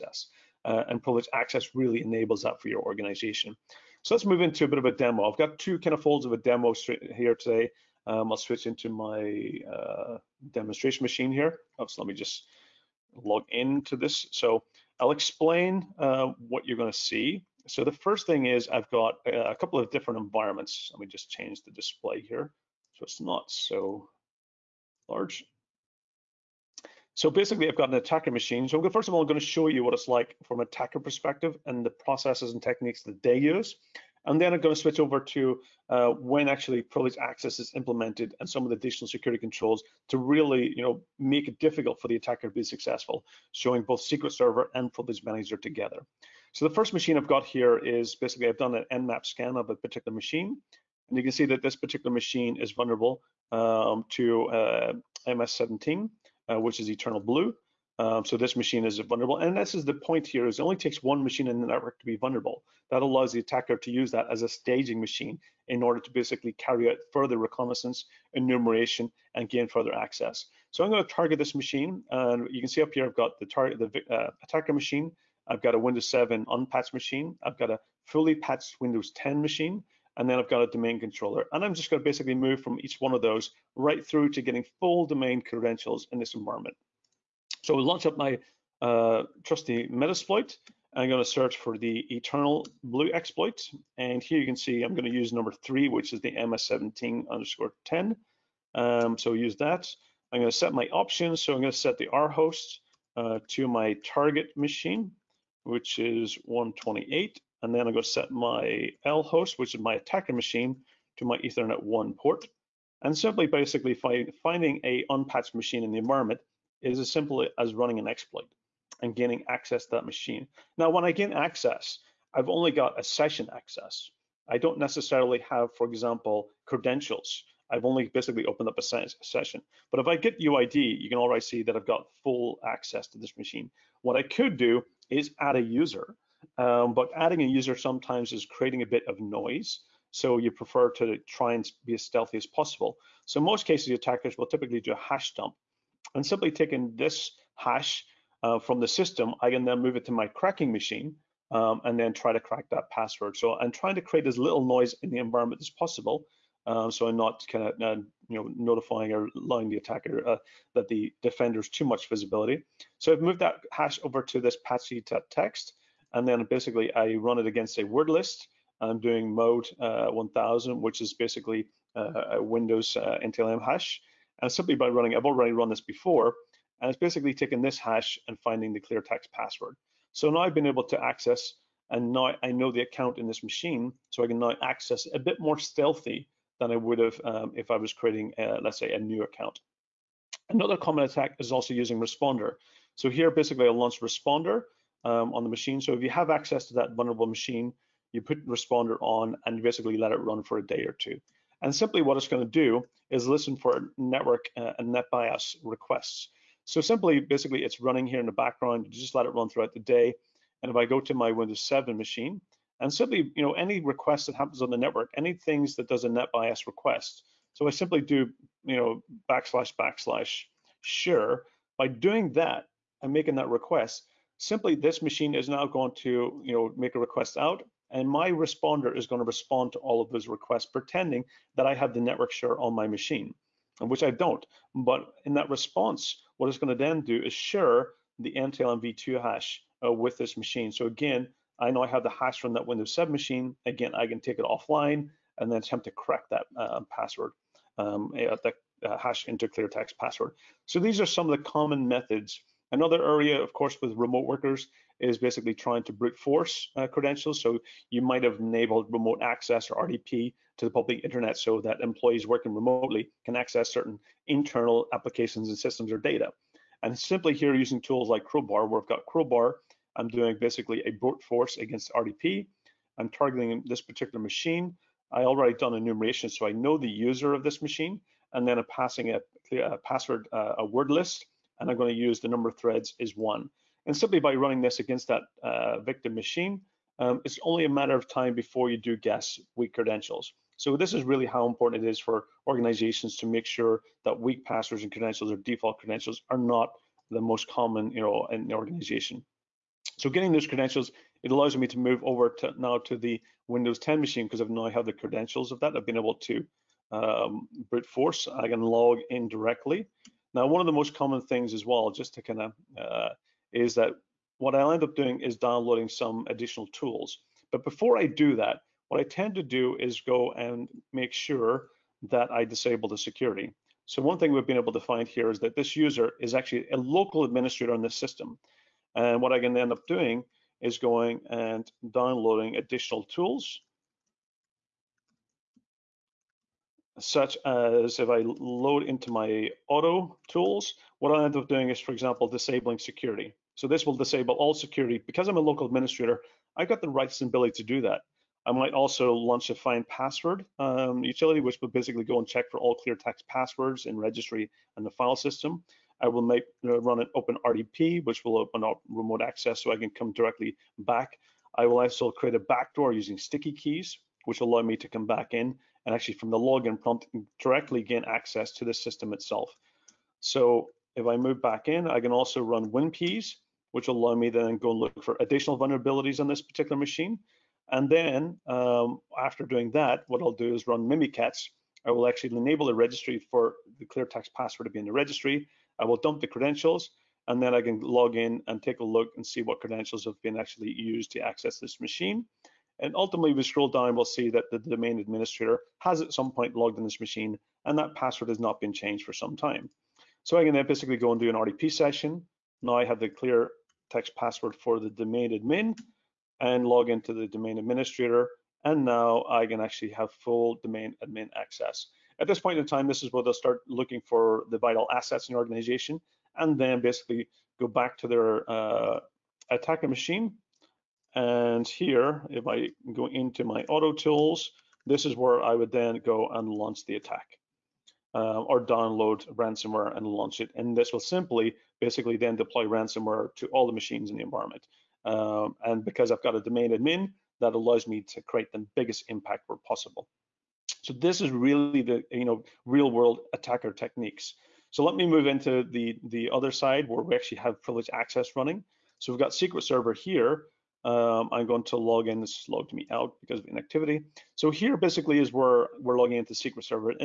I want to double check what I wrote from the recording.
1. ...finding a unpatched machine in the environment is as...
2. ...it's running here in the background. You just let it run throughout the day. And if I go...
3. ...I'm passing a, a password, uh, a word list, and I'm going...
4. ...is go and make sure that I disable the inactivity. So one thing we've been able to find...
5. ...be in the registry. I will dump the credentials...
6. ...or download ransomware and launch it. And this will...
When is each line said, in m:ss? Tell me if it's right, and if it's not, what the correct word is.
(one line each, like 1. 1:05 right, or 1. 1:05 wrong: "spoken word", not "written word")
1. 1:54 right
2. 3:27 right
3. 4:38 right
4. 5:19 wrong: "security", not "inactivity"
5. 6:24 right
6. 7:08 right.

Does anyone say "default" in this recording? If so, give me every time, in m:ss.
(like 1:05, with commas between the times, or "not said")
4:55.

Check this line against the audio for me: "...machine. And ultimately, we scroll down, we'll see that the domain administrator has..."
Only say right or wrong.
right.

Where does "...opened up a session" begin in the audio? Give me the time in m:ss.
2:08.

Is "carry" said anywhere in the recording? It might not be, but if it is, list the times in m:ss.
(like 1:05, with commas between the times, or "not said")
1:06.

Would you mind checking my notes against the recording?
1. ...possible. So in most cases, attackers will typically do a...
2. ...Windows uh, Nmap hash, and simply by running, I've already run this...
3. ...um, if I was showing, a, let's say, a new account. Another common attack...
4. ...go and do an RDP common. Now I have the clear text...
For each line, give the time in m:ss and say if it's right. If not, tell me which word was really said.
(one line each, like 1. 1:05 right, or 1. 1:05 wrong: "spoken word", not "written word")
1. 2:22 right
2. 2:52 wrong: "NTLM", not "Nmap"
3. 3:07 wrong: "creating", not "showing"
4. 6:40 wrong: "session", not "common".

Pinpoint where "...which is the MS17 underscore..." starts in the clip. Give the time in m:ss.
1:35.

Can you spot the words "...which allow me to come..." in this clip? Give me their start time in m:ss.
6:04.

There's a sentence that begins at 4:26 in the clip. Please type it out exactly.
And simply here using tools like Crowbar, where I've got Crowbar, I'm doing basically a brute force against RDP.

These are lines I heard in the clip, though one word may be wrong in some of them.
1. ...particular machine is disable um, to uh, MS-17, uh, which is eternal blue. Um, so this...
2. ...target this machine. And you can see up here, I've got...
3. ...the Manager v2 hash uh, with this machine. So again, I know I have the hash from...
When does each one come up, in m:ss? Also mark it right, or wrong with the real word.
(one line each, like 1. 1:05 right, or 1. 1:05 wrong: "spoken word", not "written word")
1. 0:51 wrong: "vulnerable", not "disable"
2. 1:11 right
3. 3:58 wrong: "NTLM", not "Manager".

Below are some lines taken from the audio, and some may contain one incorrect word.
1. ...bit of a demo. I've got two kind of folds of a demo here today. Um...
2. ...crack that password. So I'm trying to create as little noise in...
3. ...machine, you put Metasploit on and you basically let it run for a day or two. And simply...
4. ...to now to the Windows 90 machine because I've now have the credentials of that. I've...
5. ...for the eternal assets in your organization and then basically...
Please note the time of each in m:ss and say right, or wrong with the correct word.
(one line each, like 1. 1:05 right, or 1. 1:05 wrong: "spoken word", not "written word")
1. 0:04 right
2. 2:32 right
3. 3:17 wrong: "Responder", not "Metasploit"
4. 5:02 wrong: "10", not "90"
5. 6:54 wrong: "vital", not "eternal".